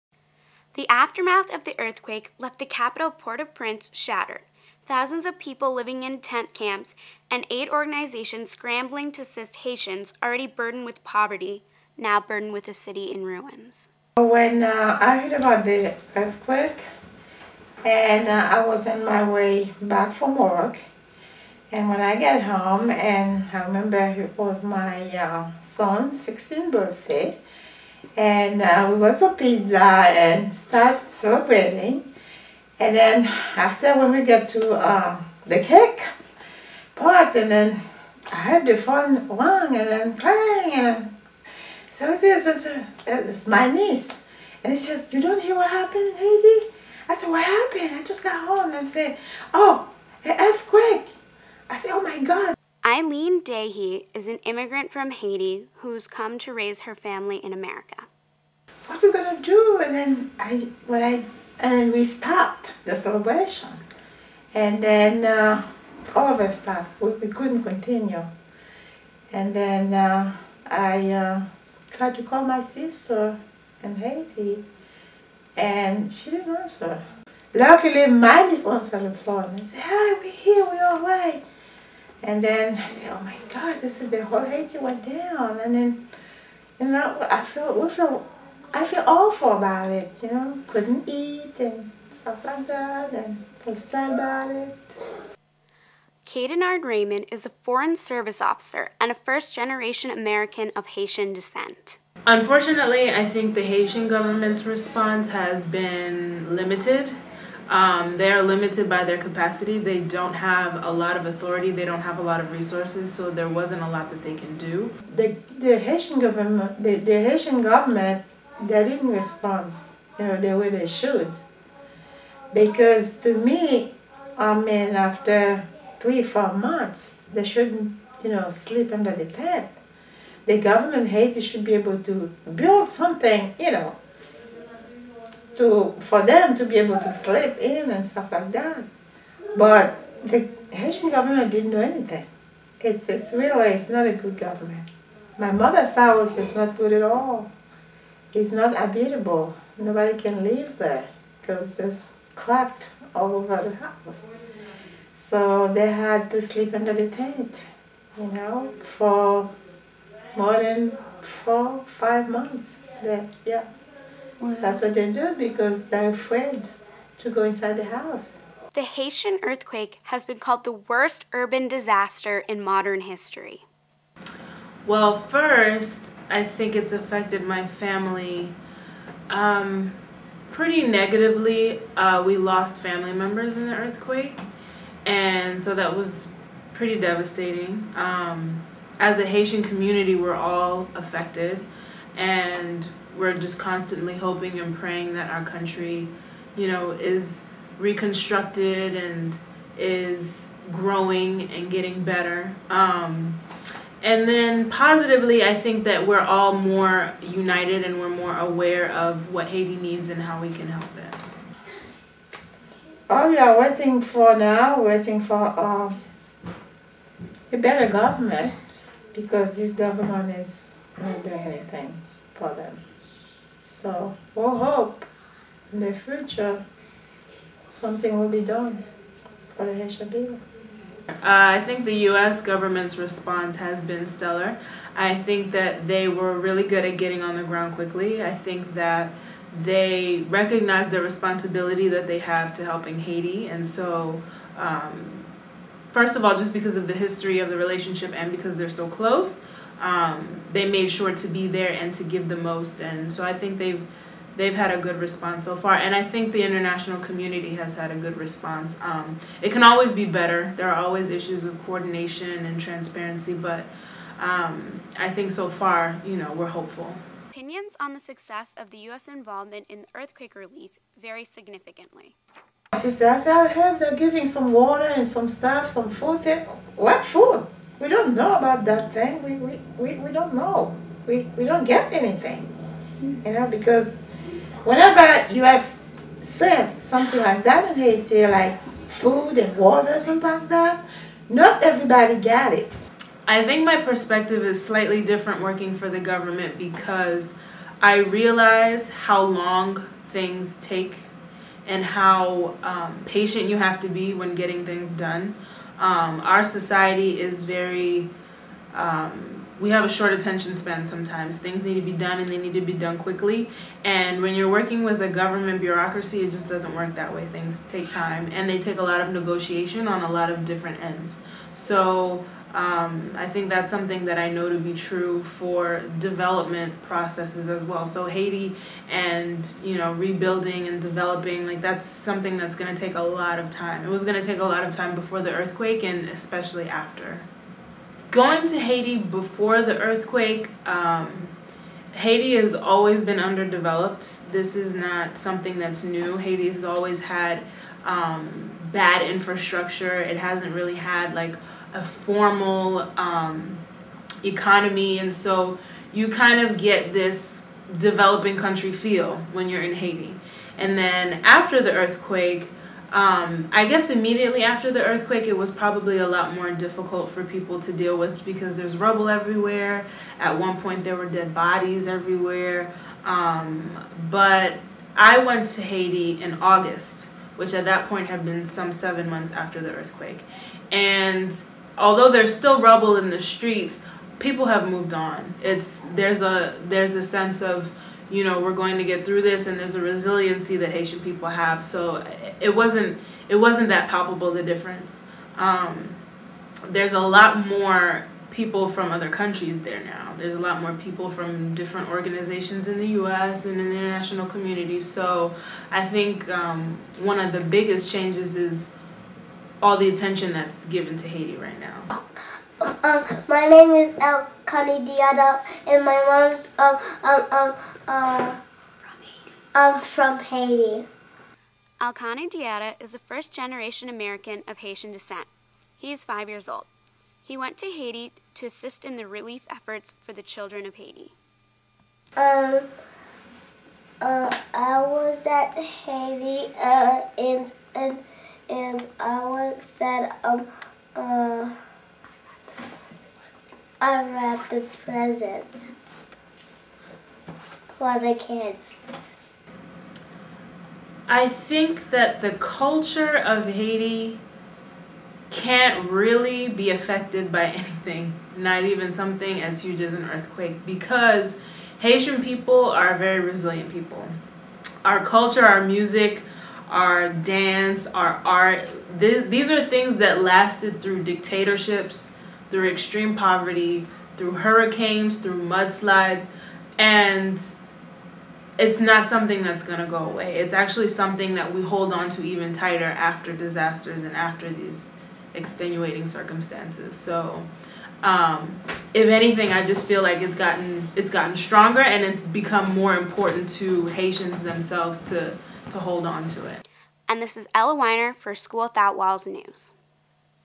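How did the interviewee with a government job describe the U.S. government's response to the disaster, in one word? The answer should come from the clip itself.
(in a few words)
Stellar.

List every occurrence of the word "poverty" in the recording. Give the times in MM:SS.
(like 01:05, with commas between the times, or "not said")
00:11, 07:53.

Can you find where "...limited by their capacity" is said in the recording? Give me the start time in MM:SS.
01:48.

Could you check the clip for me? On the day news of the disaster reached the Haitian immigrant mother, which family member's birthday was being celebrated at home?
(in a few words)
Her son's 16th birthday.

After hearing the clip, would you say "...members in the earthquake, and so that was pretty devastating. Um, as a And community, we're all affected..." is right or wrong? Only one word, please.
wrong.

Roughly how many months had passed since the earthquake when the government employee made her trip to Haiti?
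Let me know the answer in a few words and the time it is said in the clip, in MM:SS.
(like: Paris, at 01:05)
7 months, at 06:18.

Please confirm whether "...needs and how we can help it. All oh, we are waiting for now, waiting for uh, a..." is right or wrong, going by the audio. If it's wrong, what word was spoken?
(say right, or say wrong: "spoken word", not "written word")
right.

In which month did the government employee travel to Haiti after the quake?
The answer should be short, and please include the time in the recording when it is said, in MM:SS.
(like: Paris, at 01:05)
August, at 06:16.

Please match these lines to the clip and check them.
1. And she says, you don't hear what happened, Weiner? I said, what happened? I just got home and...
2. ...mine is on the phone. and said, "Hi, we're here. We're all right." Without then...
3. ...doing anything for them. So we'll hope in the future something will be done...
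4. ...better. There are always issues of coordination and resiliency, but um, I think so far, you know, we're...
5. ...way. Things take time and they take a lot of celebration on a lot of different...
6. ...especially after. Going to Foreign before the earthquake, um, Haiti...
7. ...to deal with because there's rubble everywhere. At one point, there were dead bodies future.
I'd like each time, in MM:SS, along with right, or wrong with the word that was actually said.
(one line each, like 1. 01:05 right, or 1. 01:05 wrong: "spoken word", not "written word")
1. 00:44 wrong: "Haiti", not "Weiner"
2. 01:18 wrong: "And", not "Without"
3. 03:41 right
4. 04:20 wrong: "transparency", not "resiliency"
5. 05:17 wrong: "negotiation", not "celebration"
6. 05:36 wrong: "Haiti", not "Foreign"
7. 06:07 wrong: "everywhere", not "future".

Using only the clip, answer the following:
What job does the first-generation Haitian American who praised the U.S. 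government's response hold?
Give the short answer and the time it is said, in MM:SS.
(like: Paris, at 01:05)
Foreign Service officer, at 01:37.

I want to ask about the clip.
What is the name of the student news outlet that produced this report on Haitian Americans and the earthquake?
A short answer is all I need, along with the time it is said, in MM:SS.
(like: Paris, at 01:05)
School Without Walls News, at 08:18.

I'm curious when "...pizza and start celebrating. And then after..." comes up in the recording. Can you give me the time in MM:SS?
00:29.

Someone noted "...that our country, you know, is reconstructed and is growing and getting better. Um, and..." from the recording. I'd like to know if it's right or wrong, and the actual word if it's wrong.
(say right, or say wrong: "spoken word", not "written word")
right.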